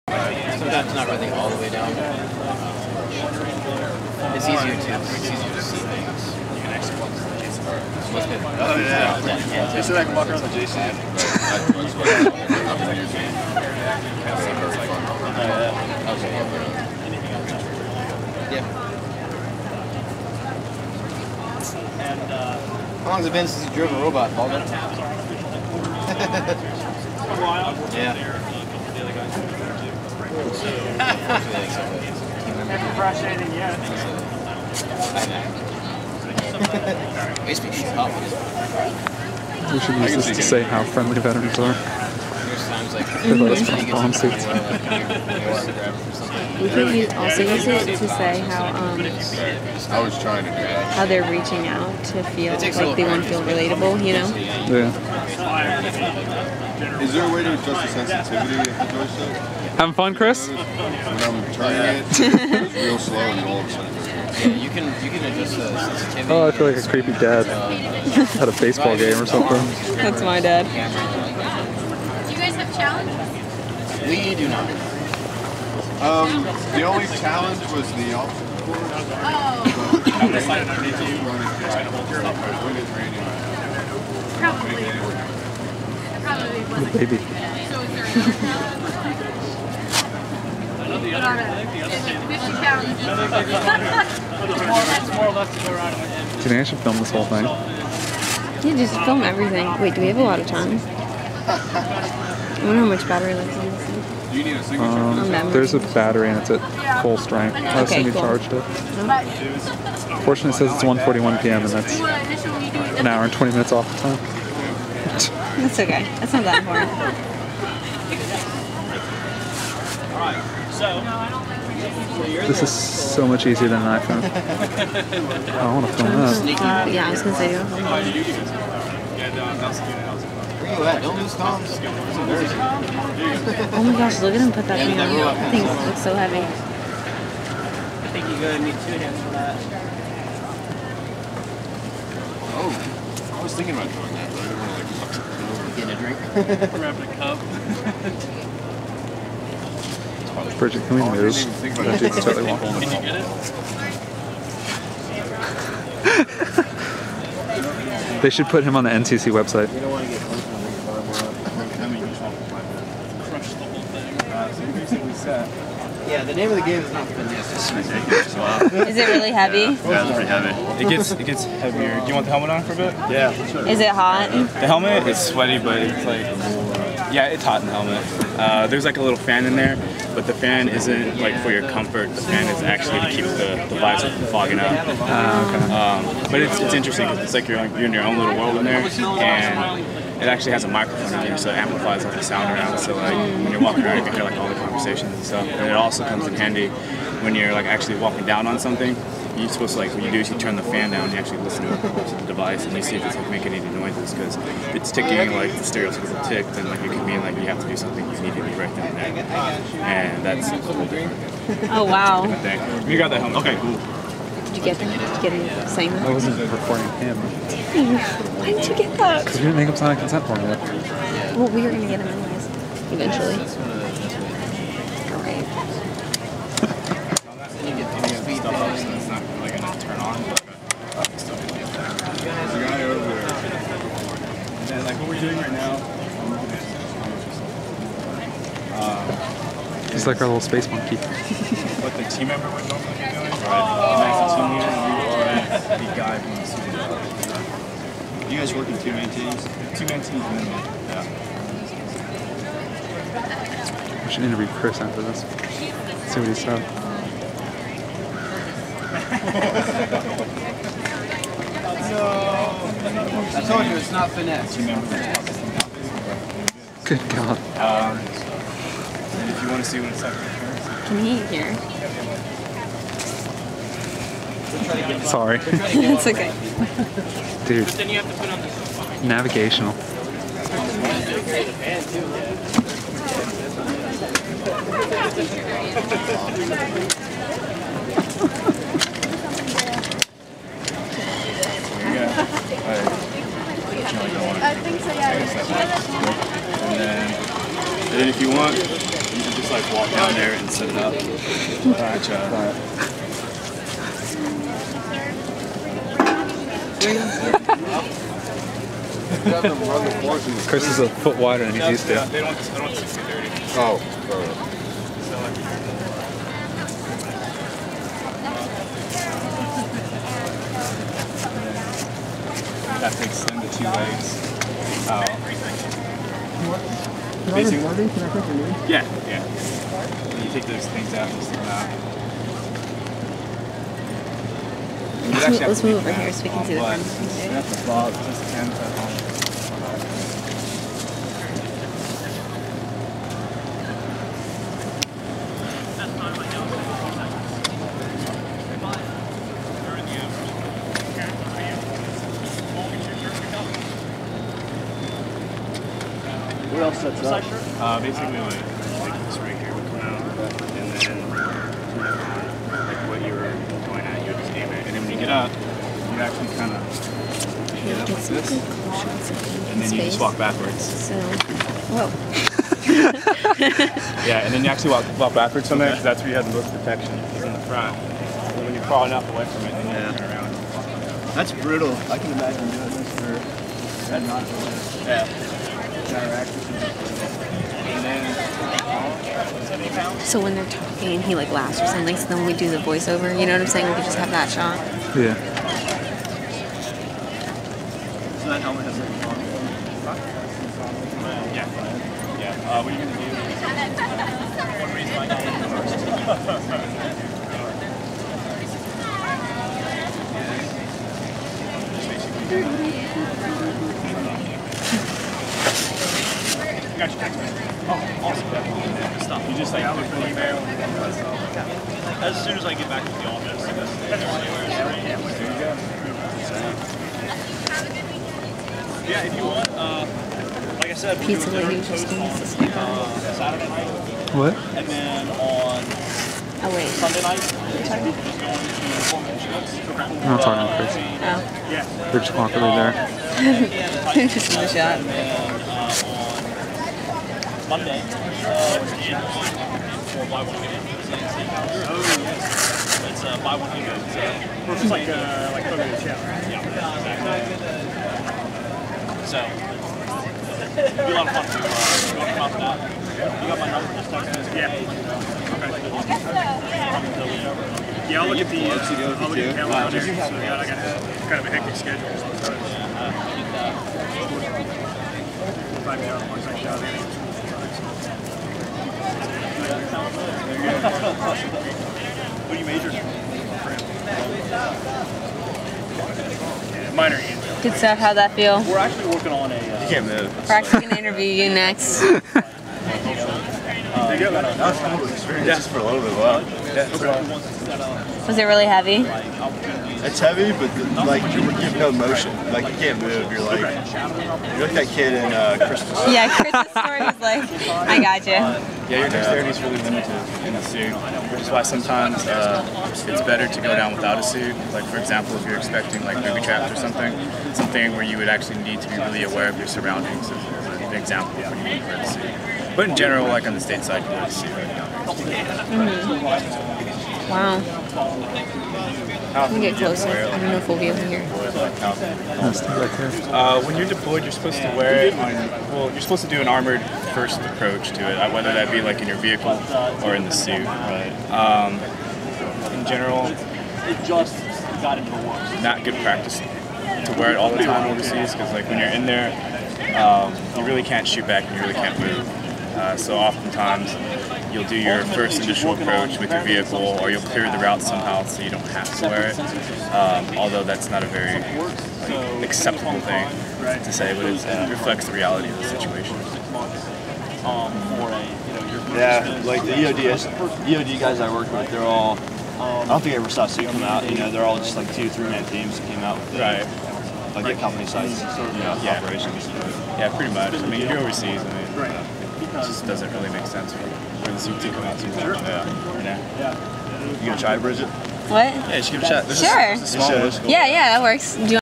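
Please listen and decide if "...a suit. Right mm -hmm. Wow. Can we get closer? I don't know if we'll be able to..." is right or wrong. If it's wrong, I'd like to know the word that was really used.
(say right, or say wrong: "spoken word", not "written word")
right.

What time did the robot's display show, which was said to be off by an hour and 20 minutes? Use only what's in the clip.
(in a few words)
1:41 p.m.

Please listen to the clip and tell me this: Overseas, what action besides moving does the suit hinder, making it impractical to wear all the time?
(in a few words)
Shoot back.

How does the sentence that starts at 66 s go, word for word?
Oh, I feel like a creepy dad uh, at a baseball game or something.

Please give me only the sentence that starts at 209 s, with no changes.
And that's a whole different, Oh wow.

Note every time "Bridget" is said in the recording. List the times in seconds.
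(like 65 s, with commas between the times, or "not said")
150 s, 587 s.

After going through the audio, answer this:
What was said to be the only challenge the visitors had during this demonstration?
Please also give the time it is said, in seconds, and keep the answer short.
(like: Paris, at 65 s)
The obstacle course, at 78 s.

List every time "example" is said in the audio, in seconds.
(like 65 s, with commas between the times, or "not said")
514 s, 520 s.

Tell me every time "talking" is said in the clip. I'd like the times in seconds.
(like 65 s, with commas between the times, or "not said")
390 s, 440 s.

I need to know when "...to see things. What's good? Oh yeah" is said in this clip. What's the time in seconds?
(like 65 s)
5 s.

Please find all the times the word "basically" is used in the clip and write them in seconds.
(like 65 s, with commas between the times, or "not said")
357 s.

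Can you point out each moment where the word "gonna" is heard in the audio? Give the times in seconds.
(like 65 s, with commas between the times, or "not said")
127 s, 138 s, 402 s, 490 s, 587 s.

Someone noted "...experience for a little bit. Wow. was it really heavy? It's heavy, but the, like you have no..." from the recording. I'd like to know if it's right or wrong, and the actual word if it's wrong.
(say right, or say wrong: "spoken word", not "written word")
right.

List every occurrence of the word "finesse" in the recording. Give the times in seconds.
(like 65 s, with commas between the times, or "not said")
167 s, 264 s.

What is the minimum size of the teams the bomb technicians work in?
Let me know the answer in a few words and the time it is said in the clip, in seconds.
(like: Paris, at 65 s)
Two-man teams, at 249 s.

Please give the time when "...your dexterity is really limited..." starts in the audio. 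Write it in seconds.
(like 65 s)
508 s.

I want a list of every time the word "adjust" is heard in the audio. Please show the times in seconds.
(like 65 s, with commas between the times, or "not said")
57 s, 65 s.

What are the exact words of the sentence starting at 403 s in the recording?
One reason I got it first.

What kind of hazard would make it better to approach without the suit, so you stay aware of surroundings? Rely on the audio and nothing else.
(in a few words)
Booby traps.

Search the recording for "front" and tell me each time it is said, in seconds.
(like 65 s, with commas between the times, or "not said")
337 s, 377 s.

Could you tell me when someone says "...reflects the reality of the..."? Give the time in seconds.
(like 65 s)
564 s.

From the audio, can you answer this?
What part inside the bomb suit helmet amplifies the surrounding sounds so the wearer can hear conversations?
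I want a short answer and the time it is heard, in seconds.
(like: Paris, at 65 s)
A microphone, at 190 s.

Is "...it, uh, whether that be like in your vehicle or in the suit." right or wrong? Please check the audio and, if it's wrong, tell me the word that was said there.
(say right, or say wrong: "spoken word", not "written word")
right.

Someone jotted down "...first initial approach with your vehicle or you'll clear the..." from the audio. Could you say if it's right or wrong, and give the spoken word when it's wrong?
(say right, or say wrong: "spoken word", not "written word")
right.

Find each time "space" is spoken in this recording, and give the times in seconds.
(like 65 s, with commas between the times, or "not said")
240 s.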